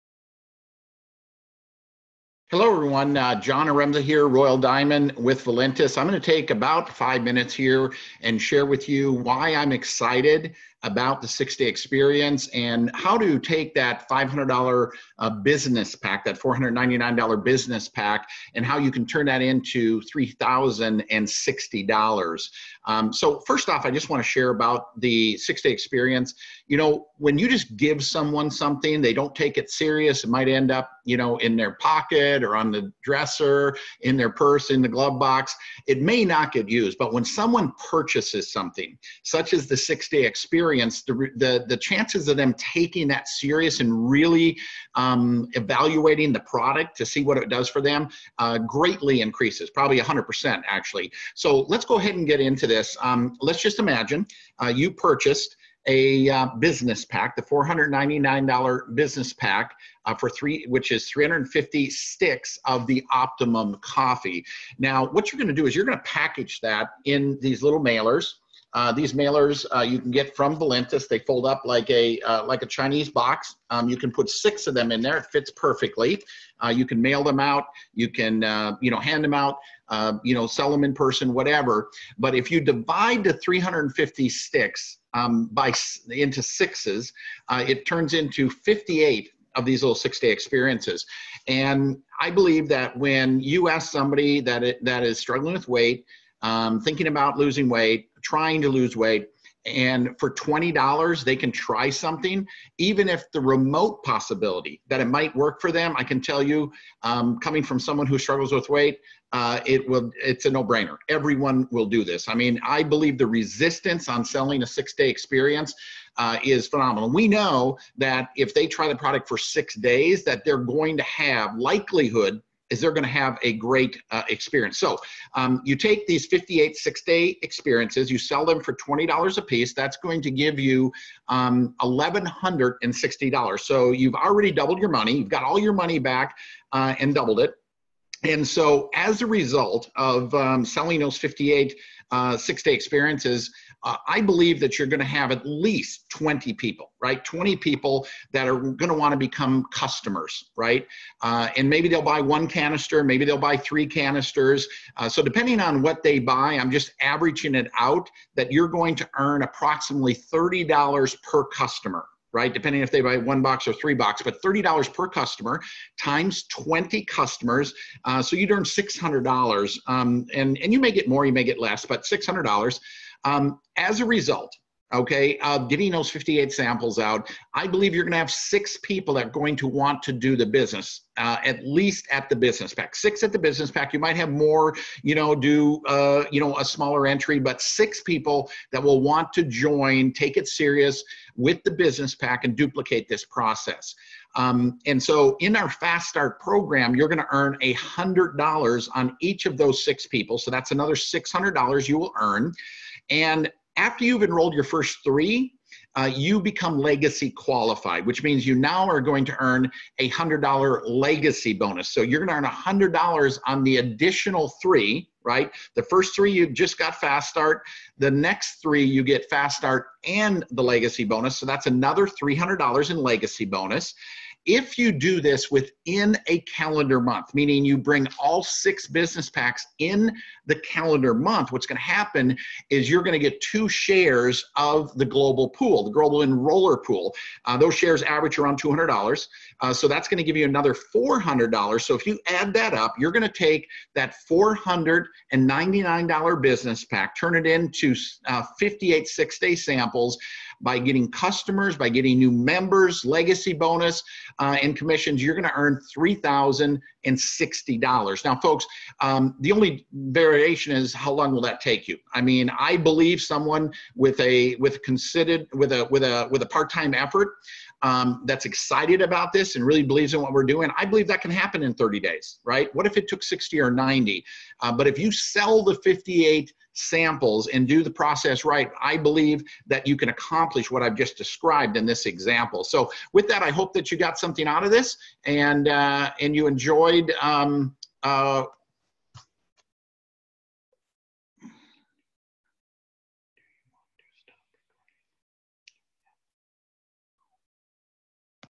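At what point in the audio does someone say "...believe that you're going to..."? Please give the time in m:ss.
2:24.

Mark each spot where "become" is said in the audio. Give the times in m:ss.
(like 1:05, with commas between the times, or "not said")
2:29, 3:26.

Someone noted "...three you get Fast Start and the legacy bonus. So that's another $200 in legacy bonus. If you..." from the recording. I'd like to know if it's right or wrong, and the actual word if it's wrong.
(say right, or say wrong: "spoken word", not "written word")
wrong: "300", not "200".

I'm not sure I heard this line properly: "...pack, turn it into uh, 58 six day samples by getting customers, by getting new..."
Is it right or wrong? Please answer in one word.
right.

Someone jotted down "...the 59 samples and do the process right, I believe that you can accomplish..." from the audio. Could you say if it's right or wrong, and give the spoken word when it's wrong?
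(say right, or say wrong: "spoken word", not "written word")
wrong: "58", not "59".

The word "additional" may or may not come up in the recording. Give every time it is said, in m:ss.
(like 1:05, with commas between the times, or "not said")
3:33.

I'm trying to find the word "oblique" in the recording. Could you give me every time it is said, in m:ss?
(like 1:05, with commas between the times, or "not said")
not said.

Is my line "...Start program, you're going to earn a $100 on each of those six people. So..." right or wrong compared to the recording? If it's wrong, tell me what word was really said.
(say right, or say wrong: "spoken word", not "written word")
right.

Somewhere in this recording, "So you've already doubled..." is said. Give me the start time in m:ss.
2:13.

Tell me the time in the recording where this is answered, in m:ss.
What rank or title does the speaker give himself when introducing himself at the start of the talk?
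0:04.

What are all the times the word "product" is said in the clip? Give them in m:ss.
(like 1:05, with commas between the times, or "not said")
0:46, 1:58.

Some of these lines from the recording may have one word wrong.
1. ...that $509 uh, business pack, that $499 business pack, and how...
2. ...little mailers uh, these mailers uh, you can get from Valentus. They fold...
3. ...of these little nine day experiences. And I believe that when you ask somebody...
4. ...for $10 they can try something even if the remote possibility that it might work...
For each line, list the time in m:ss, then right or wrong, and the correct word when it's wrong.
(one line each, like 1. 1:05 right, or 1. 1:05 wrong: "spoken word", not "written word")
1. 0:13 wrong: "500", not "509"
2. 1:07 right
3. 1:29 wrong: "six", not "nine"
4. 1:40 wrong: "20", not "10".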